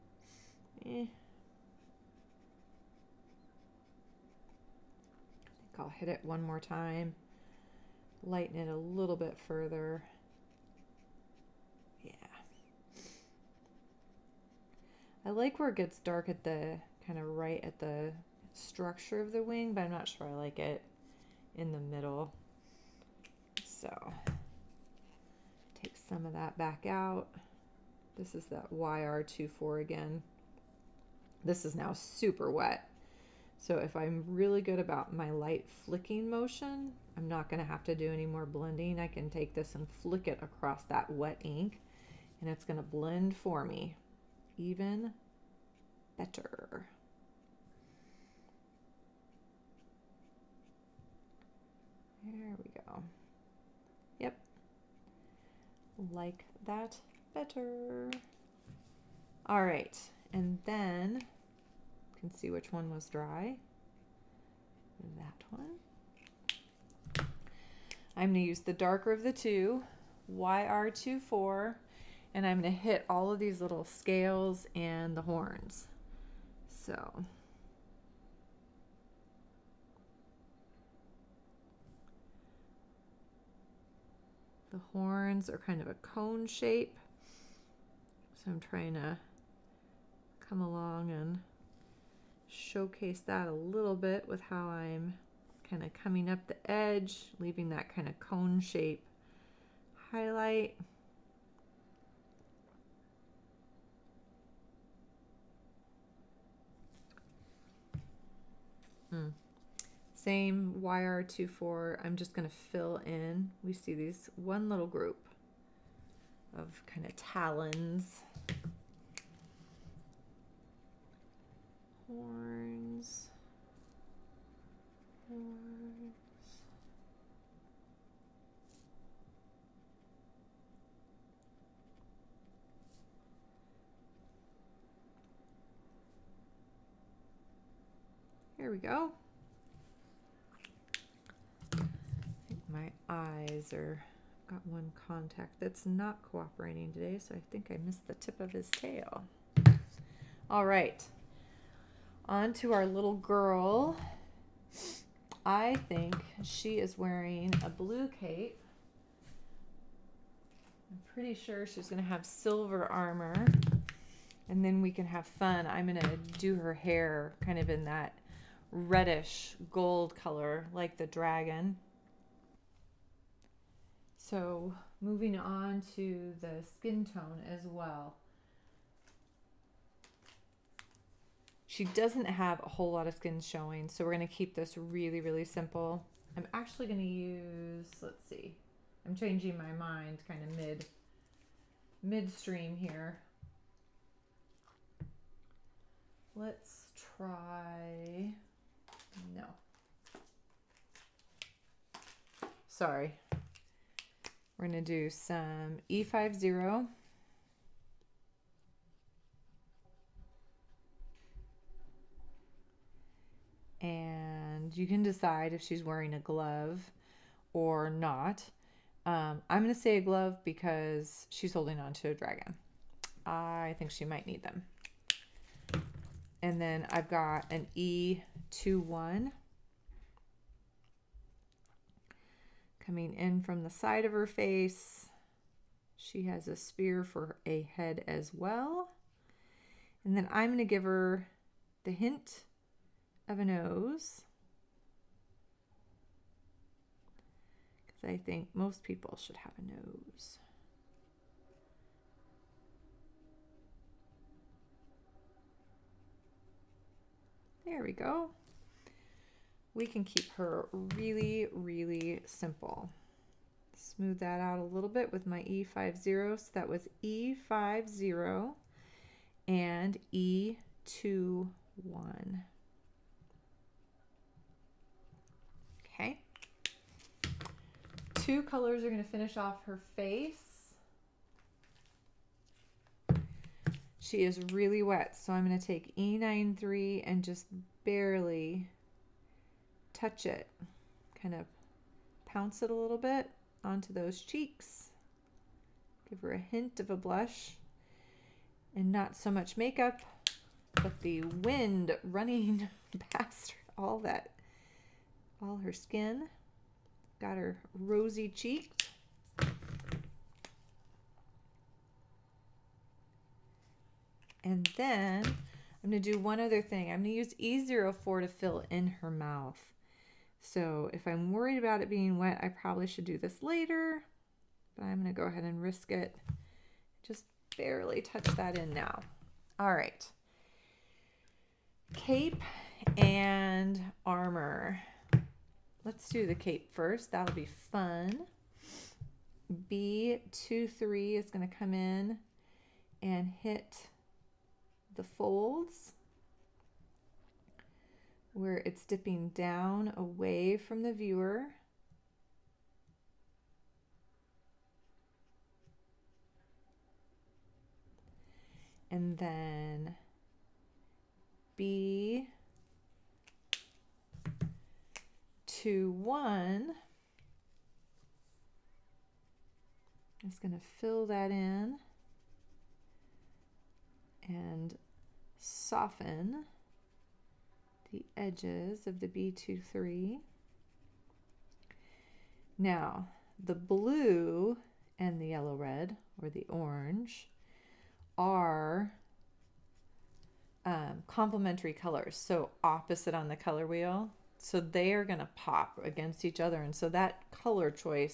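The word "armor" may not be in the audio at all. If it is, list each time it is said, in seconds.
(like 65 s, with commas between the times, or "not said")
162 s, 334 s.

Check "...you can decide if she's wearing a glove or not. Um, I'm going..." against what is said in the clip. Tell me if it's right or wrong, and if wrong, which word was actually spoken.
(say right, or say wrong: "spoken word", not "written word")
right.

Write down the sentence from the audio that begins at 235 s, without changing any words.
She has a sphere for a head as well.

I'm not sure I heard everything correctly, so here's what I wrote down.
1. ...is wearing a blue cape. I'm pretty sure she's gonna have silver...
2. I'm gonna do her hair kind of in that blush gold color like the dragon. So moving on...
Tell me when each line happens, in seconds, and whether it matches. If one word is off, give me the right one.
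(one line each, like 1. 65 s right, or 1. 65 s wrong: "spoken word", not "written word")
1. 156 s right
2. 165 s wrong: "reddish", not "blush".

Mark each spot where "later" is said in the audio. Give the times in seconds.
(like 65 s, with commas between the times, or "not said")
323 s.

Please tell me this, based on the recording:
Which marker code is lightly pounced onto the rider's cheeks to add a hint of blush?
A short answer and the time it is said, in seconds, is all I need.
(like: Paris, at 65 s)
E93, at 285 s.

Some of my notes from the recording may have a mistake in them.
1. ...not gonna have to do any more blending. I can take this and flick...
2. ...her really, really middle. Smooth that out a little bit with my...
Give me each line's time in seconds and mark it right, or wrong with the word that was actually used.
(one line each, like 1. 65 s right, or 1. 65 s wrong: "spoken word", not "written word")
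1. 37 s right
2. 260 s wrong: "simple", not "middle".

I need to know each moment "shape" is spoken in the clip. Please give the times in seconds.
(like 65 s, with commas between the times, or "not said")
86 s, 98 s.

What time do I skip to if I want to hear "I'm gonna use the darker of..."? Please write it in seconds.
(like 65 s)
68 s.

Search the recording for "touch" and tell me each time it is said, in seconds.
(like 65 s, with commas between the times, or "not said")
289 s, 327 s.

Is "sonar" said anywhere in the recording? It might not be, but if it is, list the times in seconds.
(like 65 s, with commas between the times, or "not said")
not said.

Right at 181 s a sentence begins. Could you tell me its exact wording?
She doesn't have a whole lot of skin showing, so we're going to keep this really, really simple.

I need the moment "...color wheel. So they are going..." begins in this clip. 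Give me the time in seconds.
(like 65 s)
393 s.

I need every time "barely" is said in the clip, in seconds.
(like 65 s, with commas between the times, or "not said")
287 s, 327 s.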